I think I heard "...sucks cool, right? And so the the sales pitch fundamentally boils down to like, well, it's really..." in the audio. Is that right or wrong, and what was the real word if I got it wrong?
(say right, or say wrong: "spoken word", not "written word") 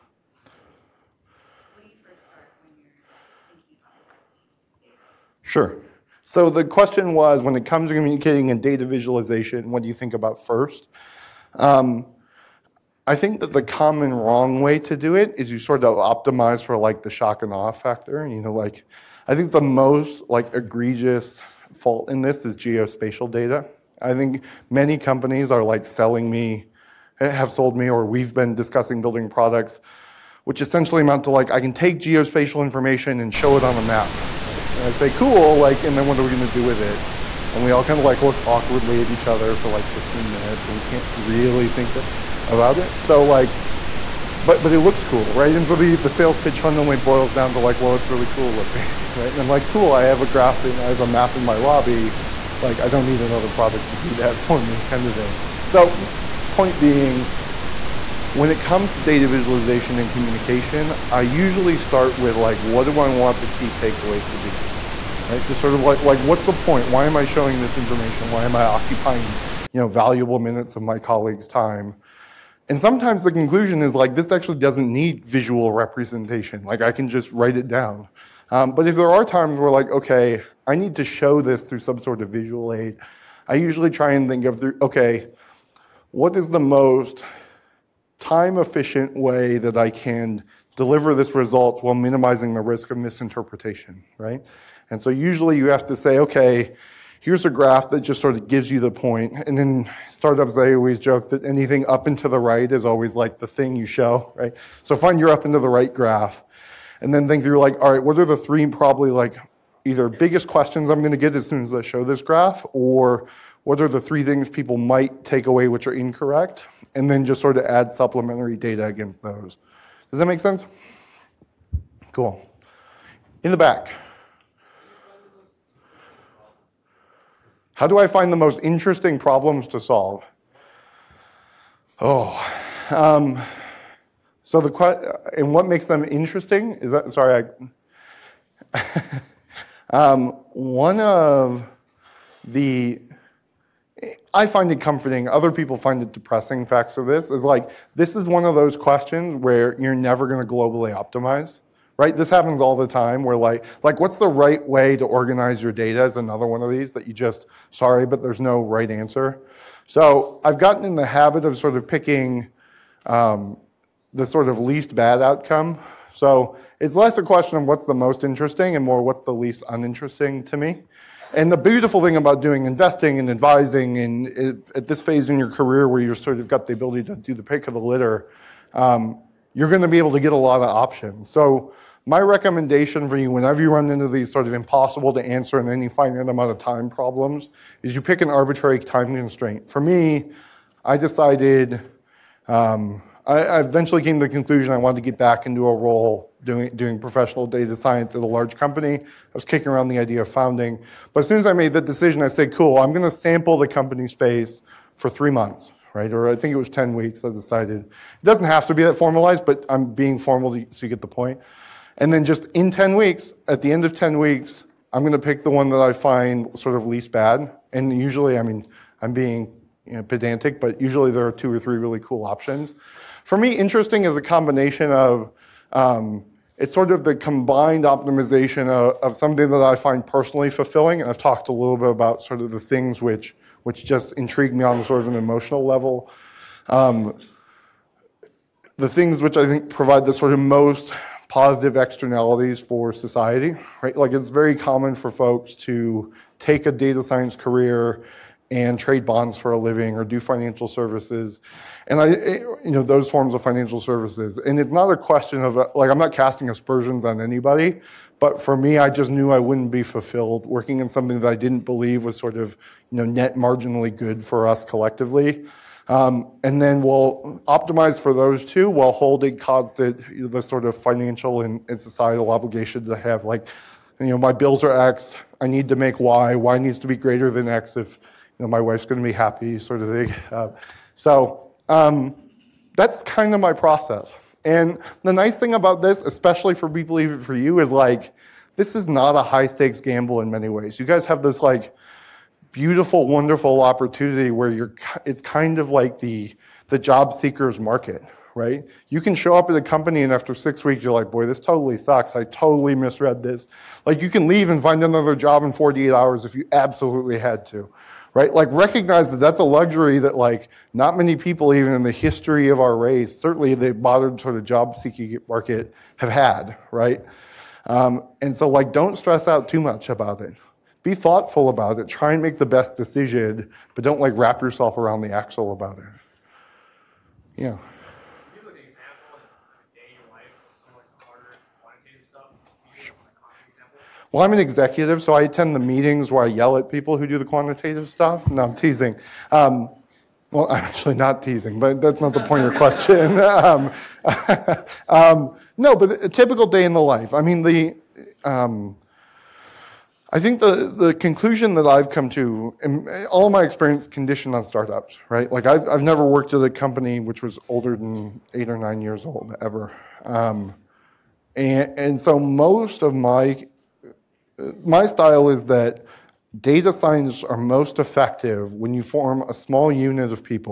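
wrong: "looks", not "sucks".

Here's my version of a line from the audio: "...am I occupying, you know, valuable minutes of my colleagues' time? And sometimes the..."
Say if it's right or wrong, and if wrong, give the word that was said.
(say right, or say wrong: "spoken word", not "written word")
right.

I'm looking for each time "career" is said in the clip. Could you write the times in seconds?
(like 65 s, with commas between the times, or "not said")
175 s, 247 s.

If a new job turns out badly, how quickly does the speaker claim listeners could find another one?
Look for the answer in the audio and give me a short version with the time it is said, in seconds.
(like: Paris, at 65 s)
48 hours, at 305 s.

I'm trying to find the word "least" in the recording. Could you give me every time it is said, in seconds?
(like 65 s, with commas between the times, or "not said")
164 s, 169 s, 216 s.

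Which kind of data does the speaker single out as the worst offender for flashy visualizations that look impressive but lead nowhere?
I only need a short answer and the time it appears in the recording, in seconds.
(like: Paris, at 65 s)
Geospatial data, at 22 s.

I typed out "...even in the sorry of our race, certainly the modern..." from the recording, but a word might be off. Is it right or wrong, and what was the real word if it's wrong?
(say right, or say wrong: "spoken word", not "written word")
wrong: "history", not "sorry".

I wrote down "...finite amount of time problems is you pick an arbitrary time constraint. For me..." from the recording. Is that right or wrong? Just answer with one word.
right.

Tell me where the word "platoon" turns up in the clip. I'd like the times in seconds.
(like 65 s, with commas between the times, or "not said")
not said.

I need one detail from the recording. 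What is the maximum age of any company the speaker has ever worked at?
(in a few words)
Eight or nine years.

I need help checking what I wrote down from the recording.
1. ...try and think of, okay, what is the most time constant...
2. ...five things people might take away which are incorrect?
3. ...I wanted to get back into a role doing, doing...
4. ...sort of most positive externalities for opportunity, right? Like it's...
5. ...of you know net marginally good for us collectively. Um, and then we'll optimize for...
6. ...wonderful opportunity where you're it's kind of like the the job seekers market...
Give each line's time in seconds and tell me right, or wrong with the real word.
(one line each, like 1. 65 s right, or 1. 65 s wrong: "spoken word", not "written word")
1. 83 s wrong: "efficient", not "constant"
2. 114 s wrong: "three", not "five"
3. 194 s right
4. 240 s wrong: "society", not "opportunity"
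5. 262 s right
6. 293 s right.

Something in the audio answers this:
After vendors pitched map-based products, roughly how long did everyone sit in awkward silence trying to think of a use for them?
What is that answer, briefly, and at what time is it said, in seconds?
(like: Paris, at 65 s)
15 minutes, at 39 s.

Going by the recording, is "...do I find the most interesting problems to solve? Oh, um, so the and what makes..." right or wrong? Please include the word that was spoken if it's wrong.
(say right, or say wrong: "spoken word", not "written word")
right.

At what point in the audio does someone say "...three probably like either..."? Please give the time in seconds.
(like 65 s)
108 s.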